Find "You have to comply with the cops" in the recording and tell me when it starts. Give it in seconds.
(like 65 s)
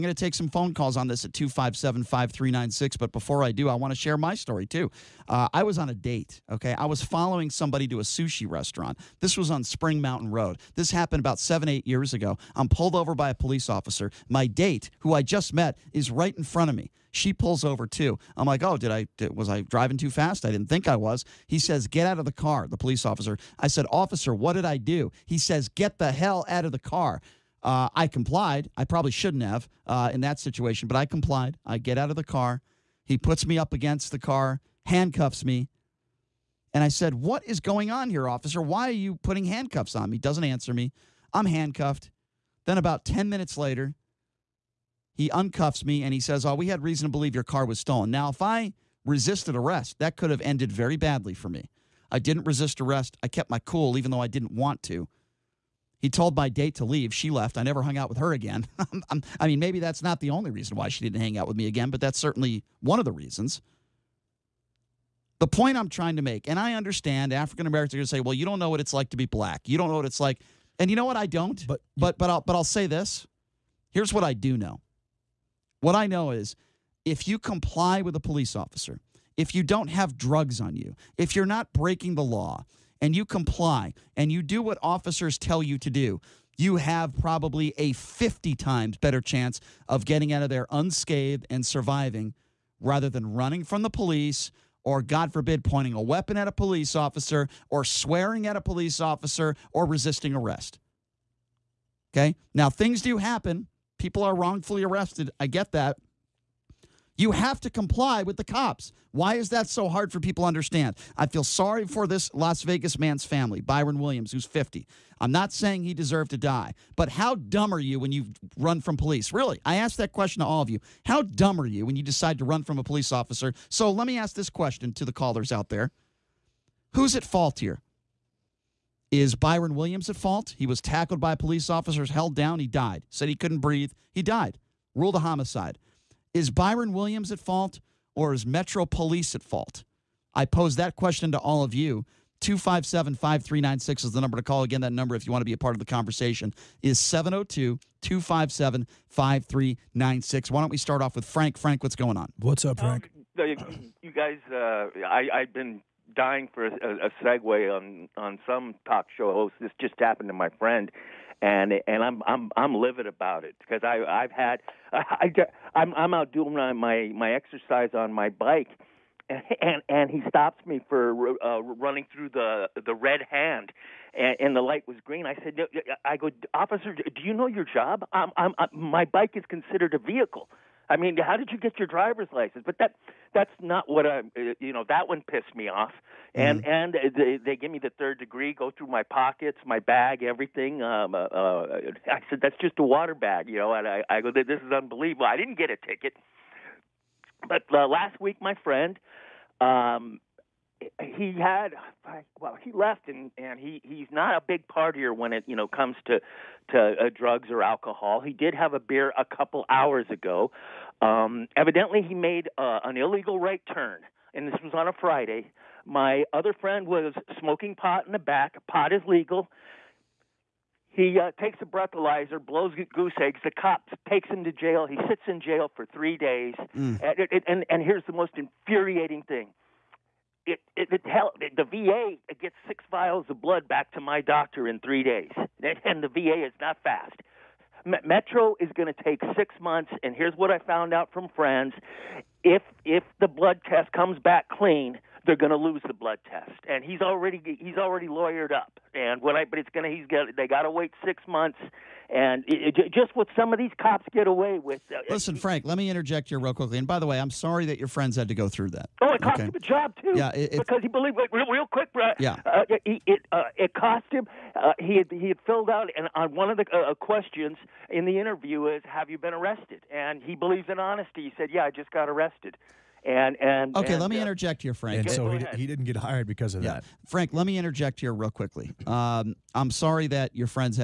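107 s.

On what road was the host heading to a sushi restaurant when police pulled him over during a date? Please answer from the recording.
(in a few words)
Spring Mountain Road.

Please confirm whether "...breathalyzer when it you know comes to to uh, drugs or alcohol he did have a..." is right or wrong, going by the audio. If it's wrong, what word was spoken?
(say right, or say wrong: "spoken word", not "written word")
wrong: "partier", not "breathalyzer".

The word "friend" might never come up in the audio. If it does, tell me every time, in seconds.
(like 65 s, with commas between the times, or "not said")
160 s, 198 s, 216 s, 241 s, 257 s.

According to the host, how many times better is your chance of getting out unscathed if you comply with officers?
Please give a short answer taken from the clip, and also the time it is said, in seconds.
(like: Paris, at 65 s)
50, at 87 s.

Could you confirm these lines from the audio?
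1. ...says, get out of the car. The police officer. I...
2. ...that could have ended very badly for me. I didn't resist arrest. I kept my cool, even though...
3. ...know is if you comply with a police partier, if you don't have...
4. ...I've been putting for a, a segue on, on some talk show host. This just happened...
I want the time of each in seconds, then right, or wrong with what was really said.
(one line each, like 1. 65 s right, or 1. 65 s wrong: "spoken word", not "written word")
1. 21 s right
2. 49 s right
3. 76 s wrong: "officer", not "partier"
4. 155 s wrong: "dying", not "putting".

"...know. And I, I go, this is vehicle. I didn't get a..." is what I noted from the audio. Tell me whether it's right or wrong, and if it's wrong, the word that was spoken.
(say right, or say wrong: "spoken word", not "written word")
wrong: "unbelievable", not "vehicle".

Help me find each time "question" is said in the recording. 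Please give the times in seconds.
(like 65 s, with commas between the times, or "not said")
120 s, 124 s, 140 s, 266 s.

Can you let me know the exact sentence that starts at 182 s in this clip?
But that that's not what I am uh, you know that one pissed me off.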